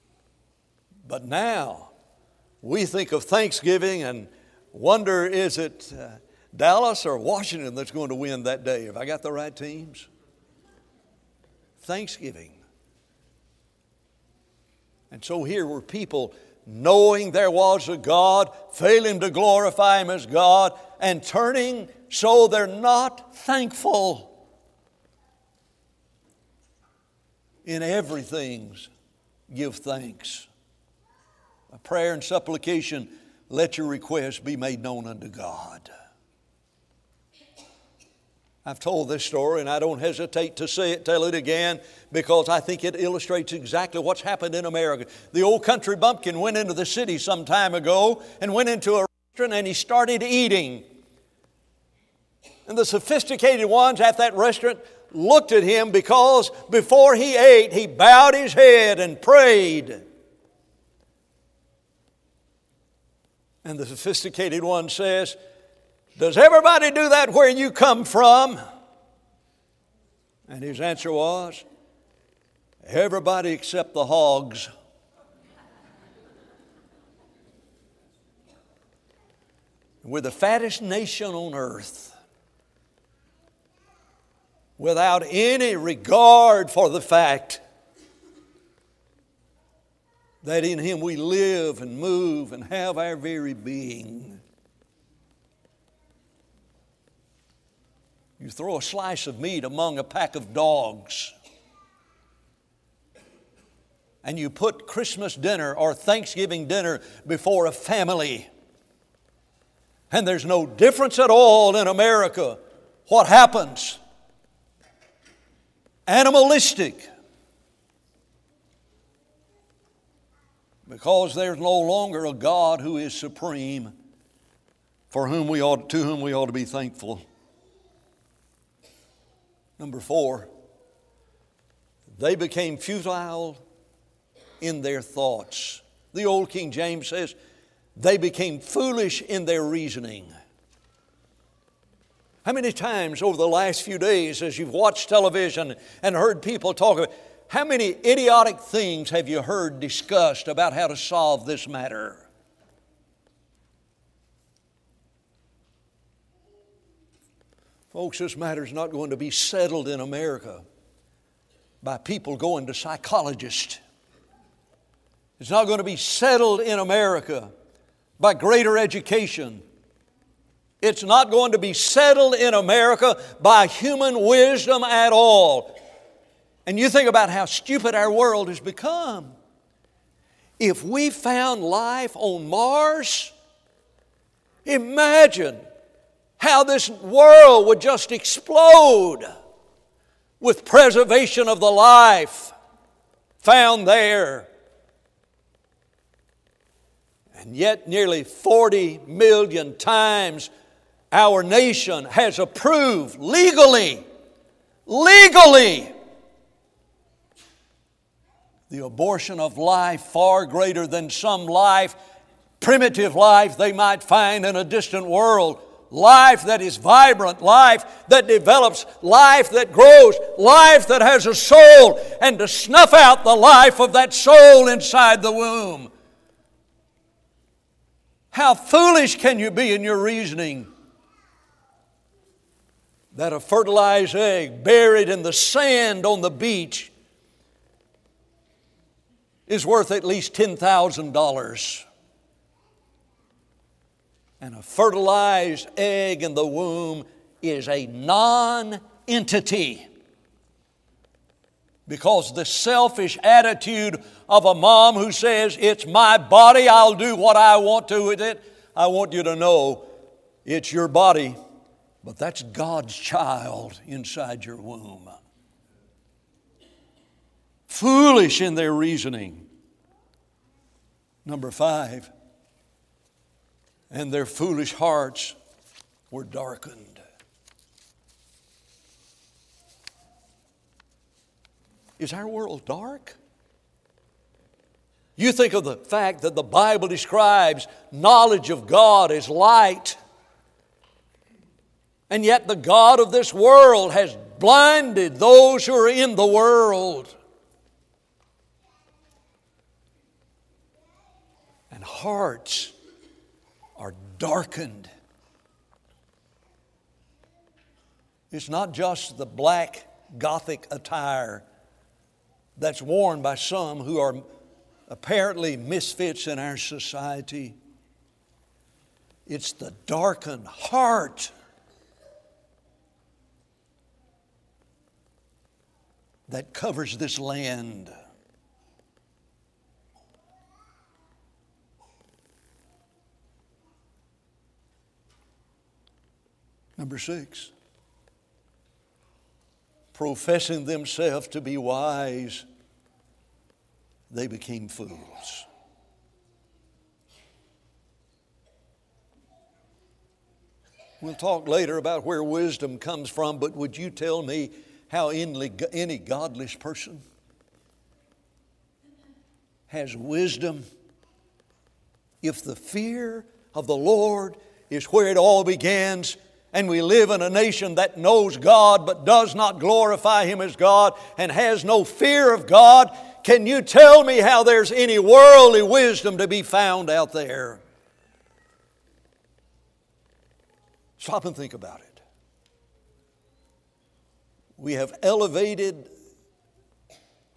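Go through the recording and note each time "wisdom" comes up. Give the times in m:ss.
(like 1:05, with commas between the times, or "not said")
2:54, 5:52, 5:59, 6:15.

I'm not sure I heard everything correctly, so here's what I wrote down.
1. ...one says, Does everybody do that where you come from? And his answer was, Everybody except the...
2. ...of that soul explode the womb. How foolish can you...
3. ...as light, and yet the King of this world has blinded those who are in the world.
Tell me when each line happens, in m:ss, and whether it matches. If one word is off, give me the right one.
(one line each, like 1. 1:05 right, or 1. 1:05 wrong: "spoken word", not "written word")
1. 1:04 right
2. 3:43 wrong: "inside", not "explode"
3. 4:49 wrong: "God", not "King".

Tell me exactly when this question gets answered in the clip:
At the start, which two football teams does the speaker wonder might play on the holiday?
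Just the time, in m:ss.
0:06.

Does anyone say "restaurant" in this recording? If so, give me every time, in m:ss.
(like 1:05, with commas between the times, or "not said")
0:49, 0:54.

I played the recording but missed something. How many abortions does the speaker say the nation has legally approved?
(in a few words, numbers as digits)
Nearly 40 million.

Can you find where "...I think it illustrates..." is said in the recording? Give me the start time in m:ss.
0:42.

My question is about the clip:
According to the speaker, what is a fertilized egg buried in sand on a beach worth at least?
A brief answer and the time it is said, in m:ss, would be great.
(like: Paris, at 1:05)
$10,000, at 4:00.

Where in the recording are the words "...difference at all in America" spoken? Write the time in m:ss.
1:50.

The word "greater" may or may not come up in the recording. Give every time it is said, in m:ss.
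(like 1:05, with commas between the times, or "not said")
2:48, 3:30.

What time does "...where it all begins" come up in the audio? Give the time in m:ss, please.
6:04.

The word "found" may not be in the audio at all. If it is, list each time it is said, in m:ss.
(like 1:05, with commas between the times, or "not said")
3:01, 3:13, 6:16.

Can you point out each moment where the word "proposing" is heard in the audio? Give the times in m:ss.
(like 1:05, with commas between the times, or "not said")
not said.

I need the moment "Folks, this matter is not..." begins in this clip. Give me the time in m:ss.
2:37.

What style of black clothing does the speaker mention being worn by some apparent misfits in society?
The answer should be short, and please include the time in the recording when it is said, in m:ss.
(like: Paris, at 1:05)
Gothic attire, at 5:10.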